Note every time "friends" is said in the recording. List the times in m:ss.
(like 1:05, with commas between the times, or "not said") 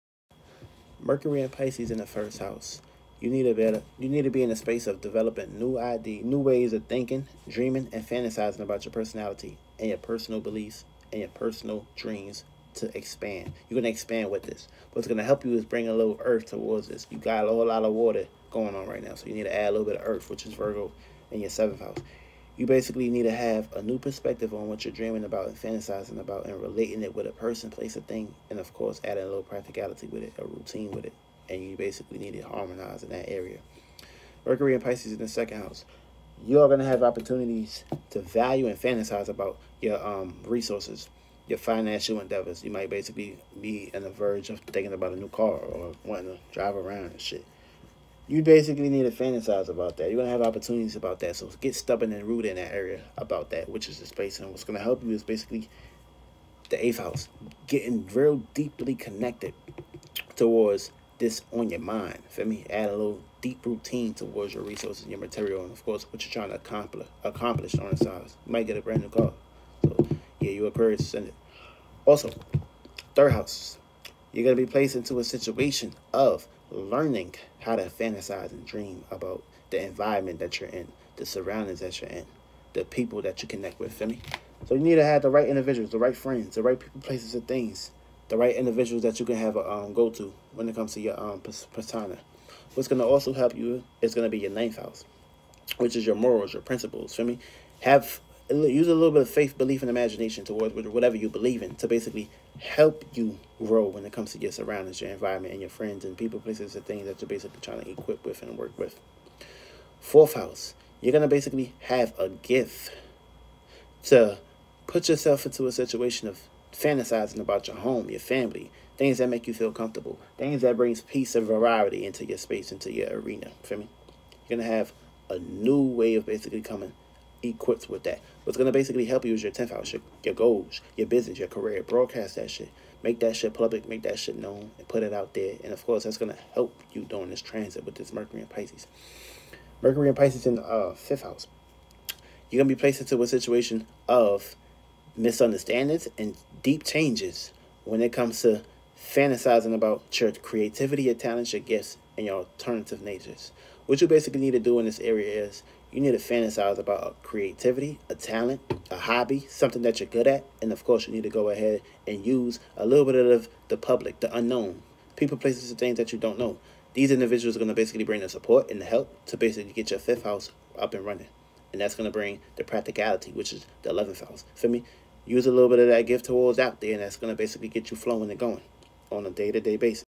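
1:26, 1:45.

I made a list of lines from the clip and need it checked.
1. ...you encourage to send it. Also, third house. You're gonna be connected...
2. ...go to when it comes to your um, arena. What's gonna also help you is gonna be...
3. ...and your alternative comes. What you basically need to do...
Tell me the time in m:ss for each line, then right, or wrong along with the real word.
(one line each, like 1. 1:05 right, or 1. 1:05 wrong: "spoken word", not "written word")
1. 1:10 wrong: "placed", not "connected"
2. 1:29 wrong: "persona", not "arena"
3. 2:32 wrong: "natures", not "comes".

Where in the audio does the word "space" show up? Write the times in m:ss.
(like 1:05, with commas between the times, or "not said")
0:04, 0:54, 2:02.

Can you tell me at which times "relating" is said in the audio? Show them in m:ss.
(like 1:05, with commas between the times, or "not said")
0:26.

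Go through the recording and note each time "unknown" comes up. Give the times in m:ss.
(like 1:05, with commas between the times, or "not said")
2:44.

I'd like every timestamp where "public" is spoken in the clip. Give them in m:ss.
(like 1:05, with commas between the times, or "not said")
2:13, 2:43.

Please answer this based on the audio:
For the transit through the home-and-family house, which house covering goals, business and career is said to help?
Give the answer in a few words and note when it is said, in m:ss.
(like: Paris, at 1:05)
10th house, at 2:09.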